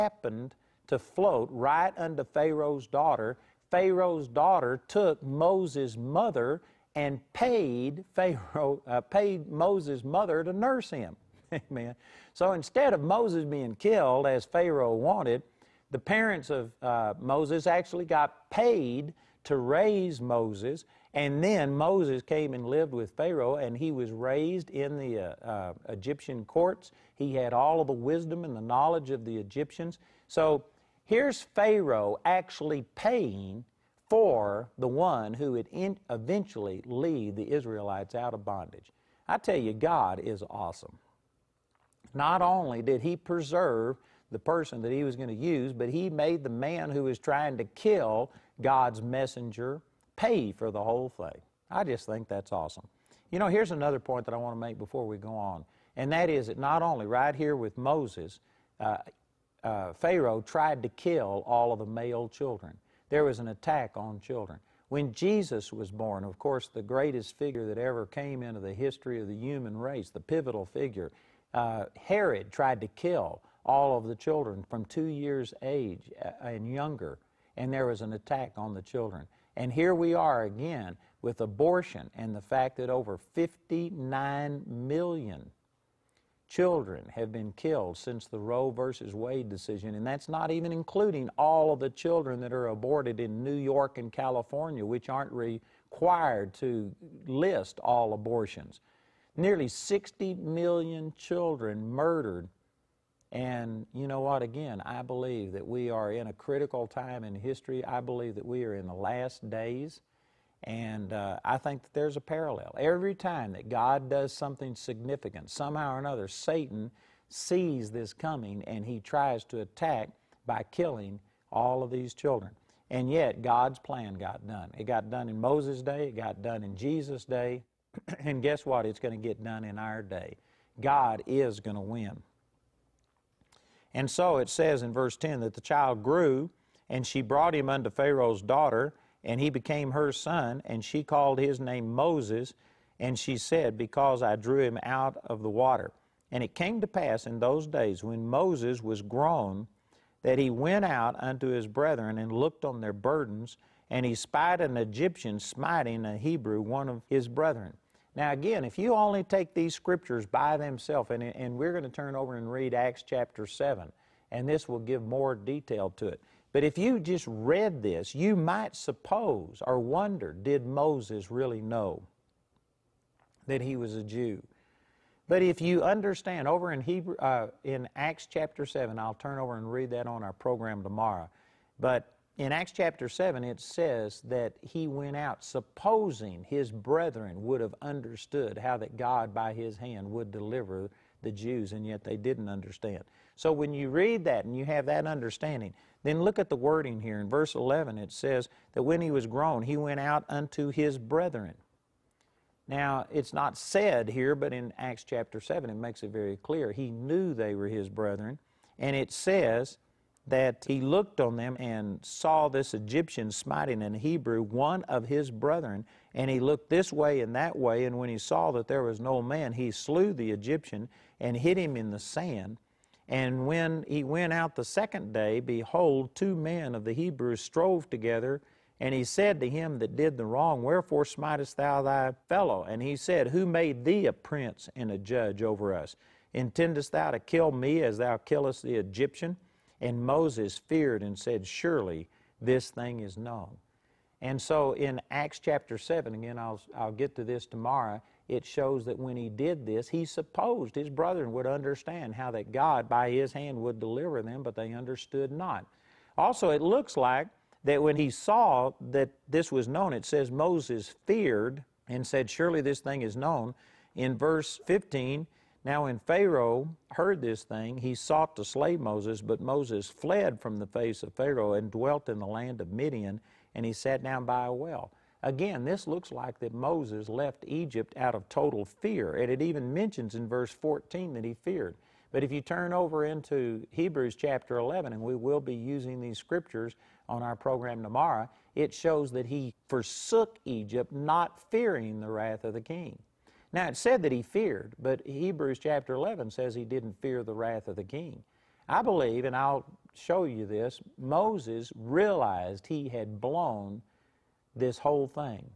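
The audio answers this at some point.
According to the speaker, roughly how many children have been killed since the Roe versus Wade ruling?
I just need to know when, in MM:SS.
01:22.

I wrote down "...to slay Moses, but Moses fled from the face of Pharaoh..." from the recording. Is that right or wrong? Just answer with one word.
right.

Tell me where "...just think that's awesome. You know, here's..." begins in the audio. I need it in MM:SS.
00:51.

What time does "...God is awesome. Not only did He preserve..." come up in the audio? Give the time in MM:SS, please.
00:39.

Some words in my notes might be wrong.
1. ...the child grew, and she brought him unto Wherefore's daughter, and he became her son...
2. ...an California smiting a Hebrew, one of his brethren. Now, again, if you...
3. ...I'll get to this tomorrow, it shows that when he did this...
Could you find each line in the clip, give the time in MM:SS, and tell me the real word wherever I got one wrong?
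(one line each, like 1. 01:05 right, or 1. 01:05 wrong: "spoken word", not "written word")
1. 02:15 wrong: "Pharaoh", not "Wherefore"
2. 02:34 wrong: "Egyptian", not "California"
3. 04:06 right.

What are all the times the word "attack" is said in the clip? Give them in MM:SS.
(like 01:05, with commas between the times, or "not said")
01:03, 01:18, 01:59.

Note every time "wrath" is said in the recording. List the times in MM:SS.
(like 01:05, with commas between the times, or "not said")
04:52, 04:57.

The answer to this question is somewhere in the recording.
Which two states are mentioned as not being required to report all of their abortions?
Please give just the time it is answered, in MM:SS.
01:33.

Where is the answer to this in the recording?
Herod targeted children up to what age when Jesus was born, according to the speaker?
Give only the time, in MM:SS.
01:14.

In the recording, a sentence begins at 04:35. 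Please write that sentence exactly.
Again, this looks like that Moses left Egypt out of total fear, and it even mentions in verse 14 that he feared.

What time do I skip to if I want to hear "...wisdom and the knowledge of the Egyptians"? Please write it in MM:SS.
00:27.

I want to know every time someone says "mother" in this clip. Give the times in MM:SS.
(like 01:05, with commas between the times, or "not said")
00:05, 00:10.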